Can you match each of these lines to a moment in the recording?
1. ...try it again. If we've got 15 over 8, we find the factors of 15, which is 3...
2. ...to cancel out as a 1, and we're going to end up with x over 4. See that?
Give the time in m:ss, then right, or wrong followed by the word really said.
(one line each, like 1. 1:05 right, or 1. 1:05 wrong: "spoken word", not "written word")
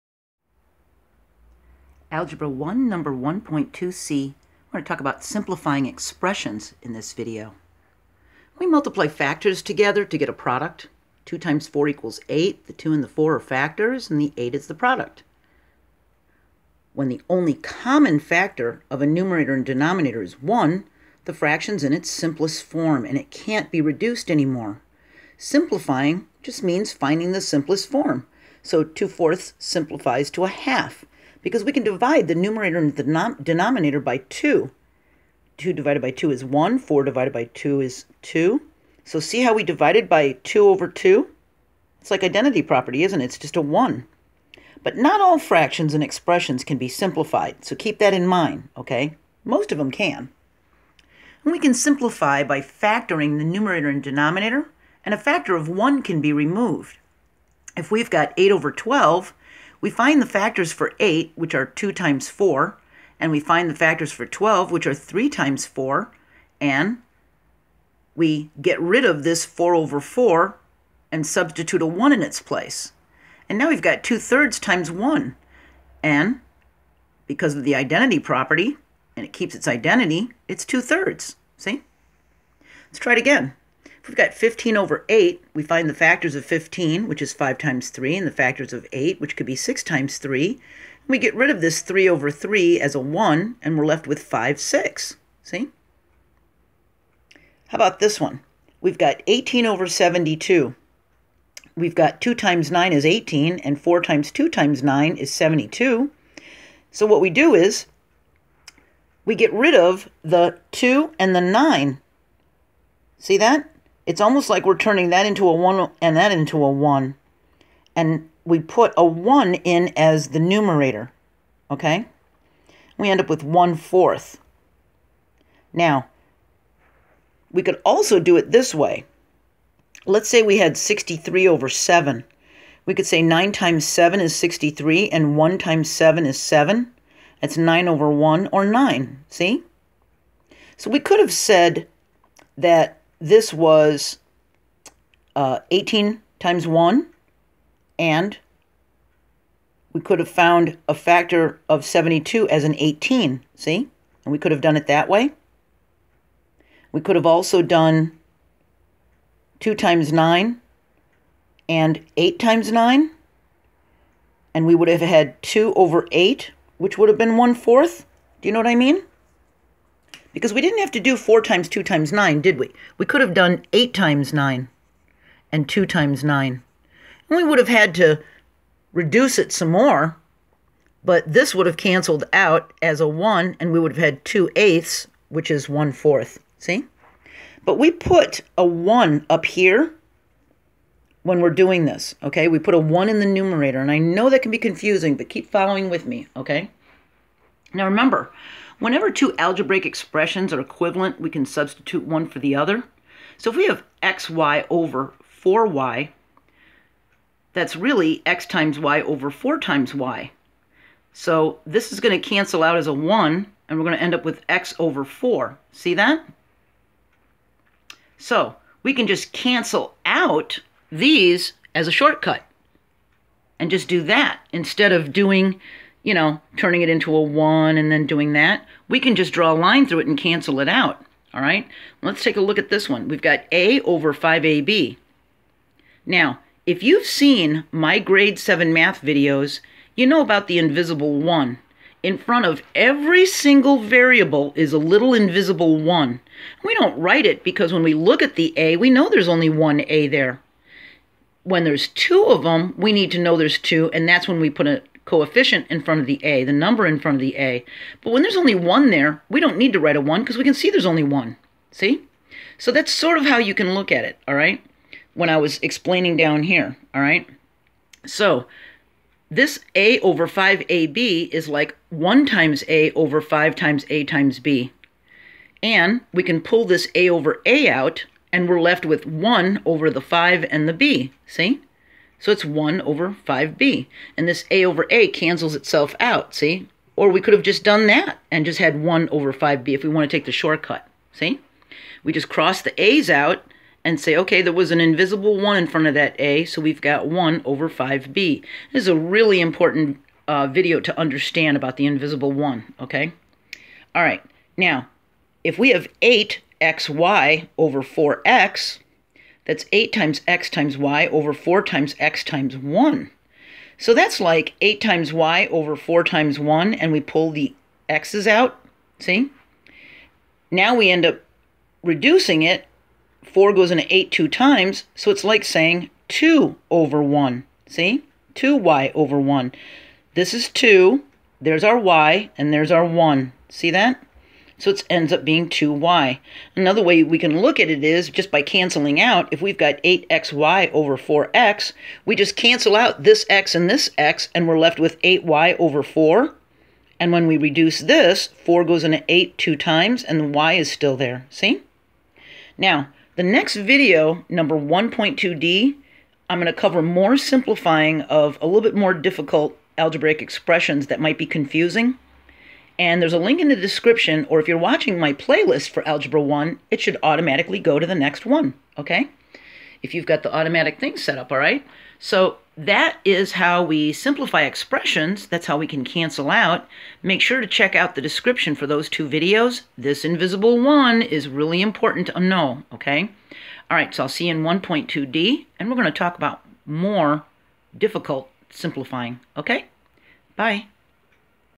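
1. 1:22 wrong: "5", not "3"
2. 3:32 right.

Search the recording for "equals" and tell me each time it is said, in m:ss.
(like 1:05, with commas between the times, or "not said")
0:11.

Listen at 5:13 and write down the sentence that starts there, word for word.
So that's like 8 times y over 4 times 1, and we pull the x's out.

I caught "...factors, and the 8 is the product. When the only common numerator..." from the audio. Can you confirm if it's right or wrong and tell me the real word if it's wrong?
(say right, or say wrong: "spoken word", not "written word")
wrong: "factor", not "numerator".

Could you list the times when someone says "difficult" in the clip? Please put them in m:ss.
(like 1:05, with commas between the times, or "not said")
5:58, 6:27.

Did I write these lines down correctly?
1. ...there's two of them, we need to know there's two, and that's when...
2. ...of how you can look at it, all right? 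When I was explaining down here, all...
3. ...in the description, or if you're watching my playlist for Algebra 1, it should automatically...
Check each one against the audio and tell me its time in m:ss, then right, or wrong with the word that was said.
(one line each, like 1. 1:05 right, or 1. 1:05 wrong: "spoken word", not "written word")
1. 4:11 right
2. 4:23 right
3. 6:03 right.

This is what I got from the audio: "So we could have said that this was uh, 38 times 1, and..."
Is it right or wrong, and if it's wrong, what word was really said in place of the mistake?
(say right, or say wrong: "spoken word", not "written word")
wrong: "18", not "38".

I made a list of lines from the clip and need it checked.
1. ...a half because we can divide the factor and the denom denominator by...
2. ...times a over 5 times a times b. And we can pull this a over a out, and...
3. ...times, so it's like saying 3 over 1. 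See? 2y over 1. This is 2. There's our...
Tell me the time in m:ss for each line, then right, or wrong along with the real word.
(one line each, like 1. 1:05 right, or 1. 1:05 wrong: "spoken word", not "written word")
1. 0:30 wrong: "numerator", not "factor"
2. 4:32 right
3. 5:24 wrong: "2", not "3".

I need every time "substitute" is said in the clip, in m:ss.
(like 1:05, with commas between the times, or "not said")
1:11, 3:21.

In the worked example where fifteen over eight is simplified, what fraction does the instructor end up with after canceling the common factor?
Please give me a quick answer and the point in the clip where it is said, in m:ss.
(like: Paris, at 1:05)
5/6, at 1:34.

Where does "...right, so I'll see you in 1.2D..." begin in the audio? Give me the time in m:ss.
6:23.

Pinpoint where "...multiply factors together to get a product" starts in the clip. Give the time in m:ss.
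0:08.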